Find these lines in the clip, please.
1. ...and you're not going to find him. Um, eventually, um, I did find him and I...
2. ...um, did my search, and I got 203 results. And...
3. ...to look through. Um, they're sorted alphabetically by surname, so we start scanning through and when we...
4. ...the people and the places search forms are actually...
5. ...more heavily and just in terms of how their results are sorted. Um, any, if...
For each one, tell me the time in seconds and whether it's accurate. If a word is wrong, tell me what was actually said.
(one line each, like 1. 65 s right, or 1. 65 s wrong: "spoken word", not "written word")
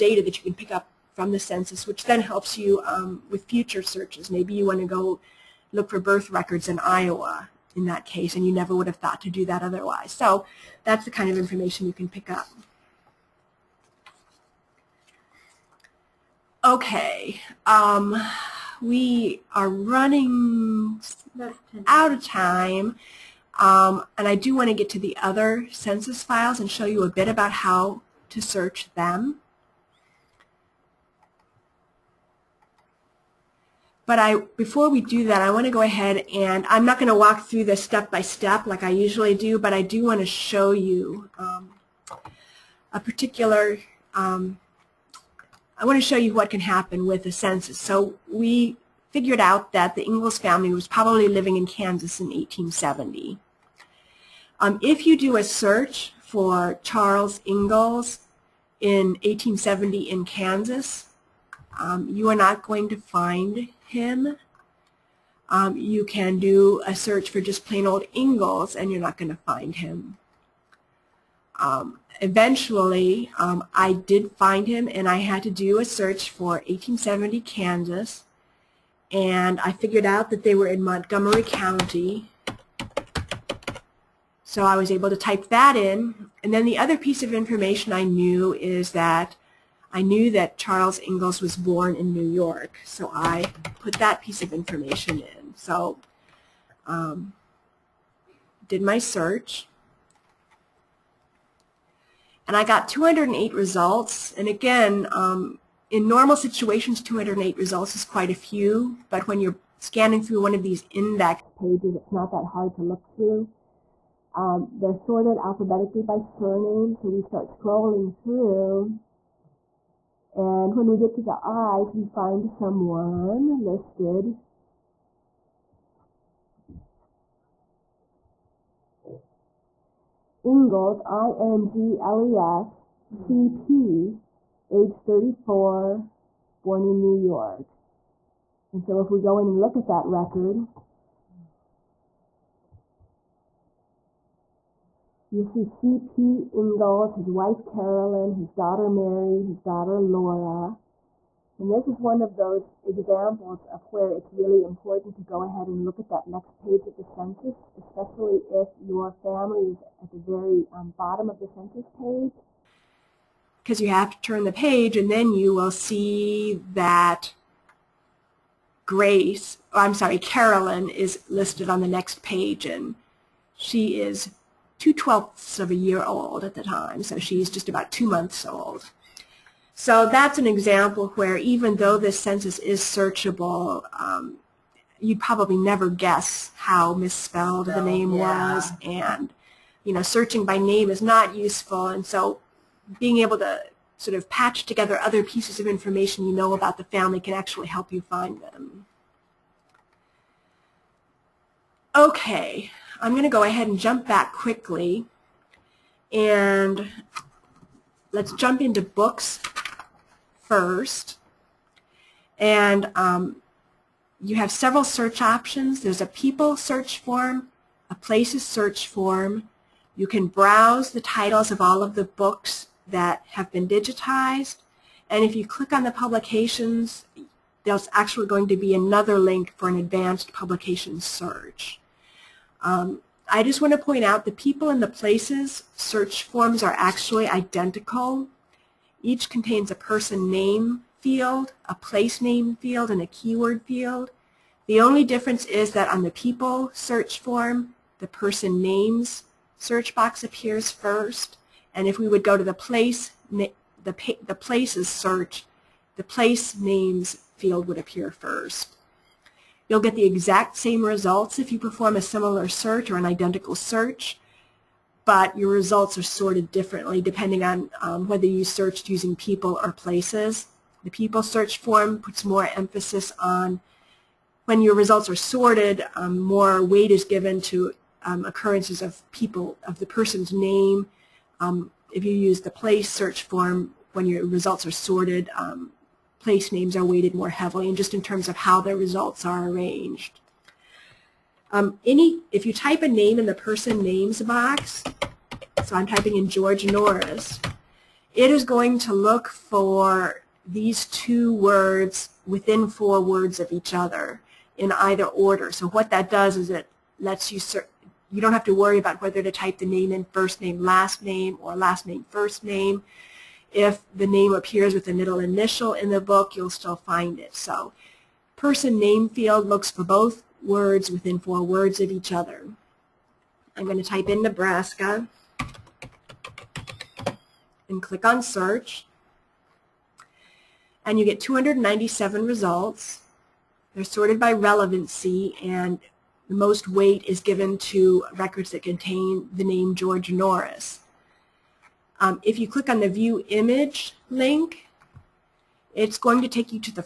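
1. 68 s right
2. 96 s wrong: "208", not "203"
3. 112 s wrong: "scrolling", not "scanning"
4. 234 s right
5. 287 s wrong: "arranged", not "sorted".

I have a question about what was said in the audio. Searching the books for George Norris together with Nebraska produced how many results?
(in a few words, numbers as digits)
297.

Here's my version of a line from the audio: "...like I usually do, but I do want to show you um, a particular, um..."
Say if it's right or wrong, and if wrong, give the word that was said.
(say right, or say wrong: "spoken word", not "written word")
right.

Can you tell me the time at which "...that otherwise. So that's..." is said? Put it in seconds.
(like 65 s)
9 s.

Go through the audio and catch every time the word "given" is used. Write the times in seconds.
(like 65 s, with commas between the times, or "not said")
277 s, 337 s.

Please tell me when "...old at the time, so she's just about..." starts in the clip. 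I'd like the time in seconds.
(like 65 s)
176 s.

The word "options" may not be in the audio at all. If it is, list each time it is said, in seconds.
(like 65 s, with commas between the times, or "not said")
215 s.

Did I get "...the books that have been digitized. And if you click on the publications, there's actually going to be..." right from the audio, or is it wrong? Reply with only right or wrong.
right.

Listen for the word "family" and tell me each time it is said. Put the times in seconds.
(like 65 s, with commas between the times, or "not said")
50 s, 159 s, 196 s.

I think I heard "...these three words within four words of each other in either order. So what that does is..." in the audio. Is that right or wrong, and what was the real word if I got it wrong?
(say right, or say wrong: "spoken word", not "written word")
wrong: "two", not "three".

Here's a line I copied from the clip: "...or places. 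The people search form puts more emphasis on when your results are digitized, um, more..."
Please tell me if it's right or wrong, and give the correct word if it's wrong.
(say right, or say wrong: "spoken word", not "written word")
wrong: "sorted", not "digitized".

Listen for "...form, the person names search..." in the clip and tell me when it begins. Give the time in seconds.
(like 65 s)
247 s.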